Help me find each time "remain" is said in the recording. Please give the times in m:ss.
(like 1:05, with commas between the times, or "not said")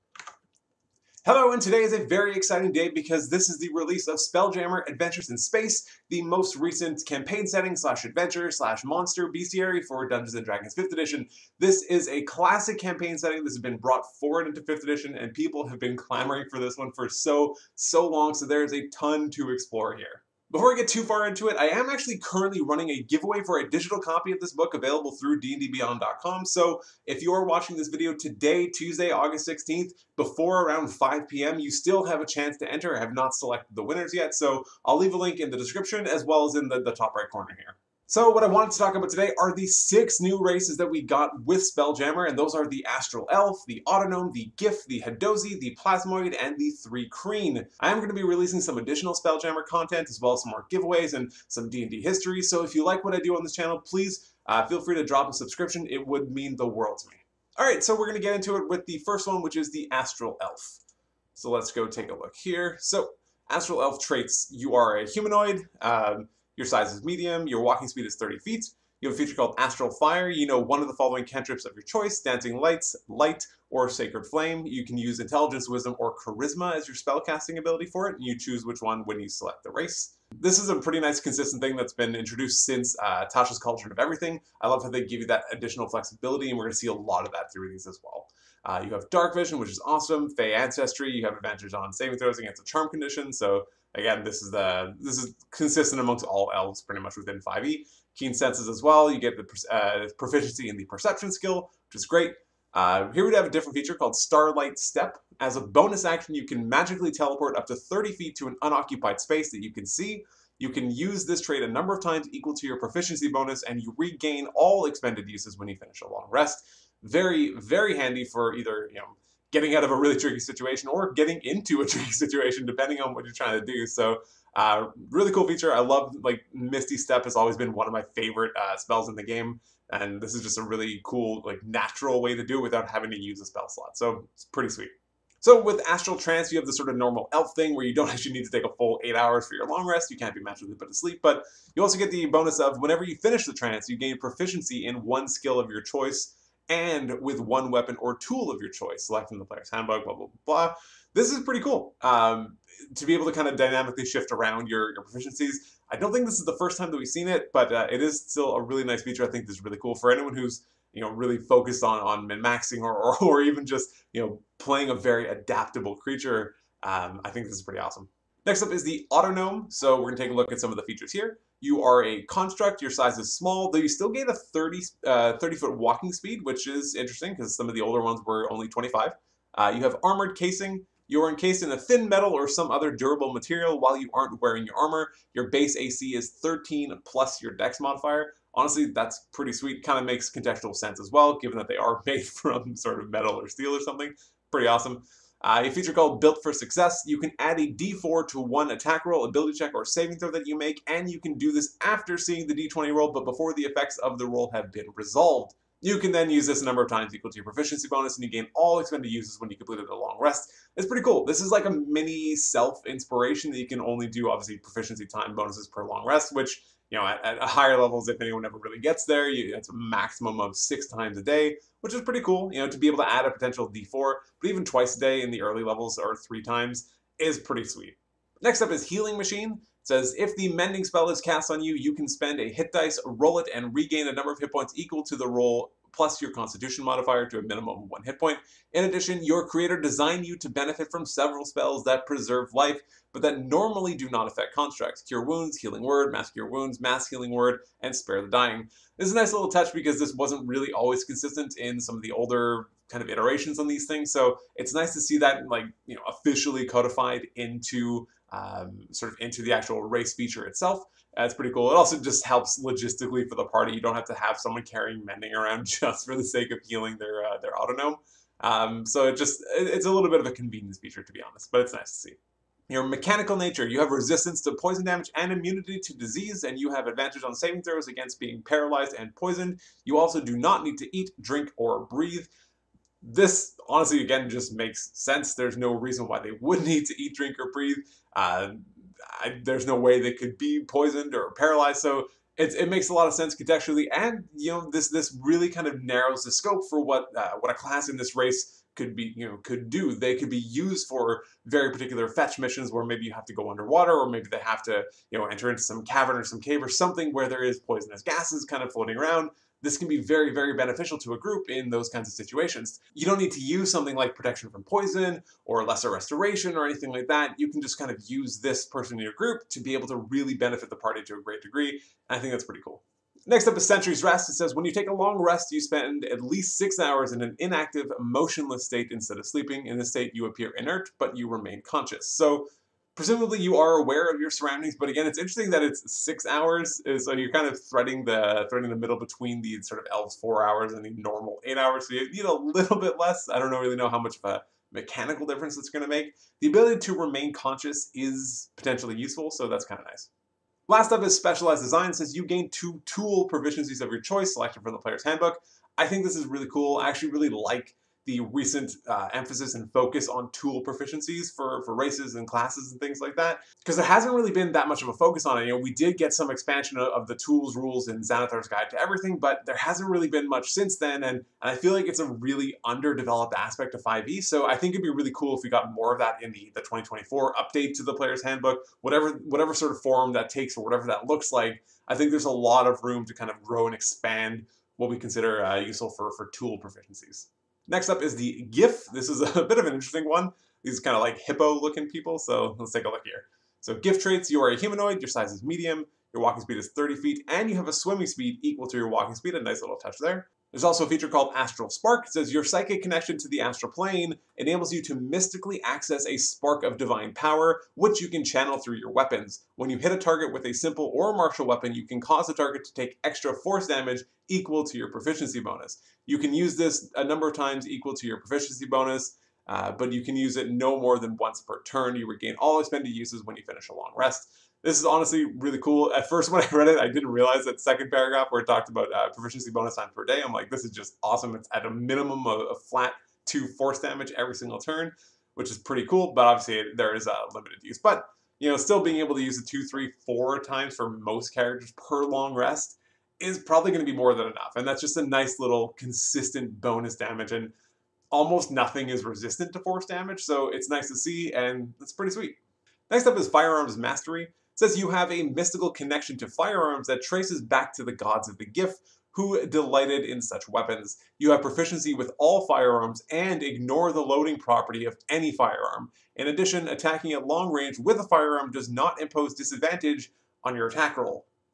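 5:31, 5:46.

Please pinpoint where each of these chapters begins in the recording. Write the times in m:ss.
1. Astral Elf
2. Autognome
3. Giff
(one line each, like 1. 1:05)
1. 0:59
2. 2:47
3. 6:24.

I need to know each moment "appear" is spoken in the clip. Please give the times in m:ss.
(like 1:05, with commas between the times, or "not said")
5:30.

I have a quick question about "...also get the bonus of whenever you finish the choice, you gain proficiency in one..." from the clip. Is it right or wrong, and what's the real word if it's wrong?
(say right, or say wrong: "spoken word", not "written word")
wrong: "trance", not "choice".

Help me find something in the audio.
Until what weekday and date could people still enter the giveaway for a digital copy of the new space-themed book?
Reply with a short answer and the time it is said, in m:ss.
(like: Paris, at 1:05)
Tuesday, August 16th, at 0:28.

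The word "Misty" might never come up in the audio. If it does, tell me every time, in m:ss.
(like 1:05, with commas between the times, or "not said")
2:06.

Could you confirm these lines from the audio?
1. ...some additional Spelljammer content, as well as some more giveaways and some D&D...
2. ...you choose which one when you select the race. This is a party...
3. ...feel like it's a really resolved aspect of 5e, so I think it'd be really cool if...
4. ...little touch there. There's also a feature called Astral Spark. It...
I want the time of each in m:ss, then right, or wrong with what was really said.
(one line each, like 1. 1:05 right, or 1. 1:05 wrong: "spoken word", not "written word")
1. 0:48 right
2. 1:18 wrong: "pretty", not "party"
3. 6:11 wrong: "underdeveloped", not "resolved"
4. 6:39 right.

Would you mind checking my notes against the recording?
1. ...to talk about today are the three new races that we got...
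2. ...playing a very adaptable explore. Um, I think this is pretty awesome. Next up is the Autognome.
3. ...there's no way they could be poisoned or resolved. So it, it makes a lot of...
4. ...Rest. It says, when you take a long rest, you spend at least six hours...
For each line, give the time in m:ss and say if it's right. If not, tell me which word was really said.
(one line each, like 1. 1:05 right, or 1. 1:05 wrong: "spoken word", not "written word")
1. 0:38 wrong: "six", not "three"
2. 2:44 wrong: "creature", not "explore"
3. 4:49 wrong: "paralyzed", not "resolved"
4. 5:24 right.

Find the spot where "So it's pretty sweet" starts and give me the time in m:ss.
2:13.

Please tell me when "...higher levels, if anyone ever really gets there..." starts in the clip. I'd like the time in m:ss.
3:37.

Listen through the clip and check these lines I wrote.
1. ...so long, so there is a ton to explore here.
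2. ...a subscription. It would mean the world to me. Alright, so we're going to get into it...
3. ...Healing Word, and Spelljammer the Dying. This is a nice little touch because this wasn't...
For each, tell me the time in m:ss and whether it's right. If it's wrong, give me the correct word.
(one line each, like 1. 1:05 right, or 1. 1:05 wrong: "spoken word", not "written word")
1. 0:17 right
2. 0:55 right
3. 4:07 wrong: "Spare", not "Spelljammer".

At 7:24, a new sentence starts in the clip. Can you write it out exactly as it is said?
And that's just a nice little consistent bonus damage.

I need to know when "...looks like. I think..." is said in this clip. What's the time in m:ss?
6:21.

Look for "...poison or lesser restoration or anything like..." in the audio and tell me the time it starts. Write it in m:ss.
5:14.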